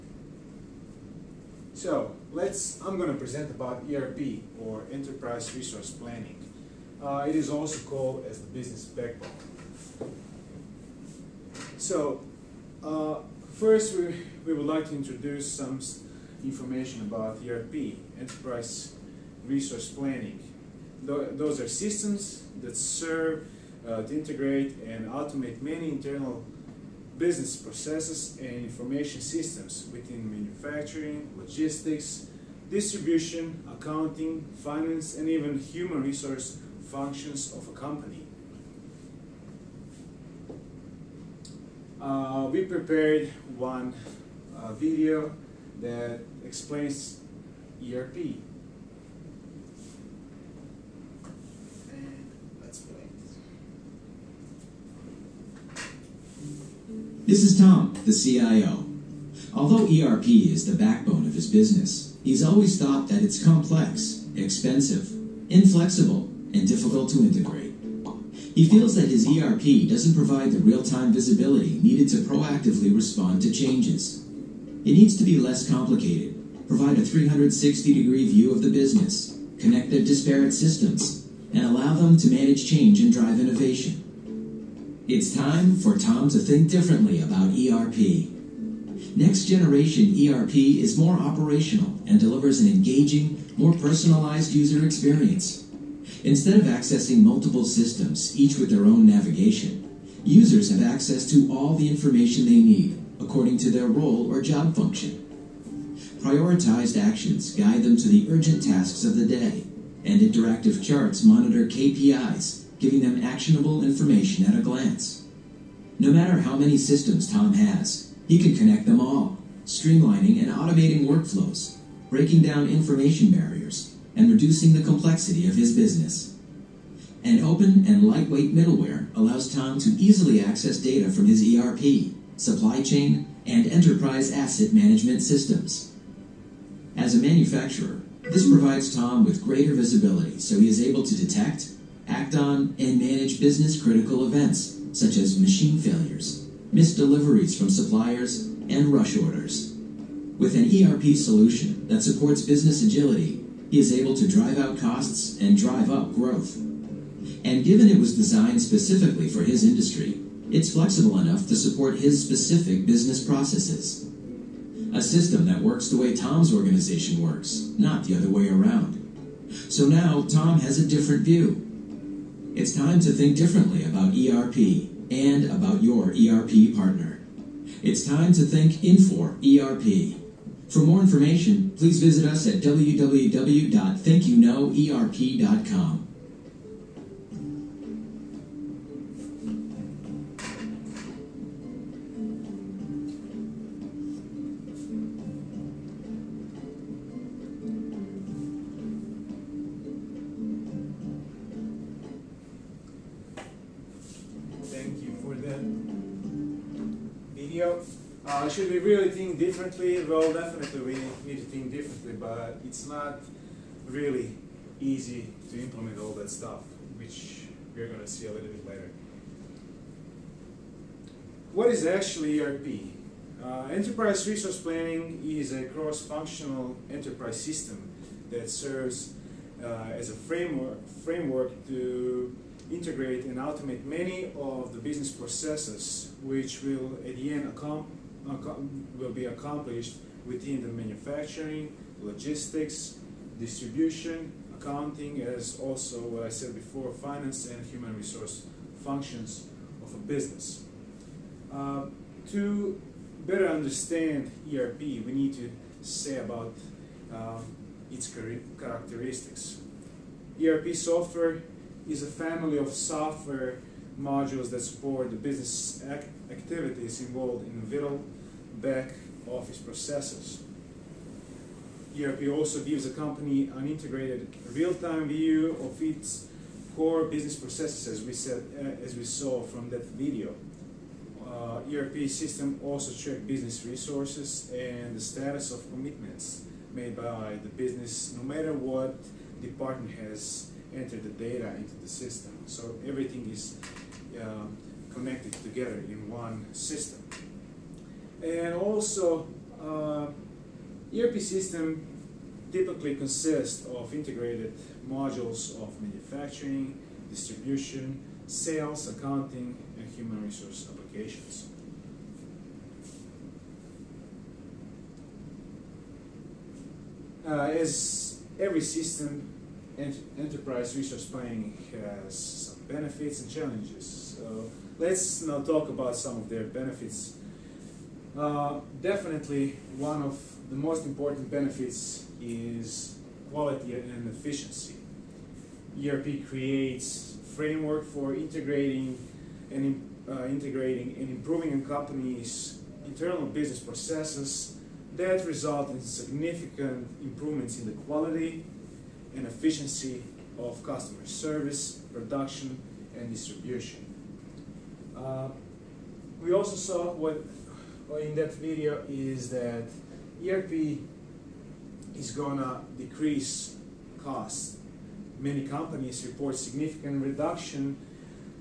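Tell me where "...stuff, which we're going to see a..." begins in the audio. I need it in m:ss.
3:36.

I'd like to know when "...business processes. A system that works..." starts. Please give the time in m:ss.
2:42.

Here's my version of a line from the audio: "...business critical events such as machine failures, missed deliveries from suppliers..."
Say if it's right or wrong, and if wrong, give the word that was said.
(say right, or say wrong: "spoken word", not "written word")
right.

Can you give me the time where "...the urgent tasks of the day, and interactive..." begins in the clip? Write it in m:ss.
1:48.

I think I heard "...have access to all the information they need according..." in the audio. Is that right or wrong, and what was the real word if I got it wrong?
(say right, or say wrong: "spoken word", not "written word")
right.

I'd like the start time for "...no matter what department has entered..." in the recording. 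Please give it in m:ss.
4:48.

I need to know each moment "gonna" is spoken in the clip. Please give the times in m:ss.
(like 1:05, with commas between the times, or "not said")
6:02.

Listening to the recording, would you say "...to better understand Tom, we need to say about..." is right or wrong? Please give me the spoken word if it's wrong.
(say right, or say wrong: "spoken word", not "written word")
wrong: "ERP", not "Tom".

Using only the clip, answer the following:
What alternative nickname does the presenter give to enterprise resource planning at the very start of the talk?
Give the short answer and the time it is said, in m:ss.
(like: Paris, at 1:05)
the business backbone, at 0:08.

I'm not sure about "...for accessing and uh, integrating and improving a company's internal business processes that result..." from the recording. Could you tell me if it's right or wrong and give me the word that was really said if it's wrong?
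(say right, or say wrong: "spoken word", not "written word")
wrong: "integrating", not "accessing".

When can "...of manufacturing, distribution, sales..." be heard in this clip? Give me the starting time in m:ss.
5:05.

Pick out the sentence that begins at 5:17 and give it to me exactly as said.
Uh, as every system, ent enterprise resource planning has some benefits and challenges.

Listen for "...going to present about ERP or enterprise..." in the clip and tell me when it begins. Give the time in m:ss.
0:02.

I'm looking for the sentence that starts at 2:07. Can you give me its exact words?
An open and lightweight middleware allows Tom to easily access data from his ERP, supply chain, and enterprise asset management systems.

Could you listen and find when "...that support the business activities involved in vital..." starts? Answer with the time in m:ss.
4:24.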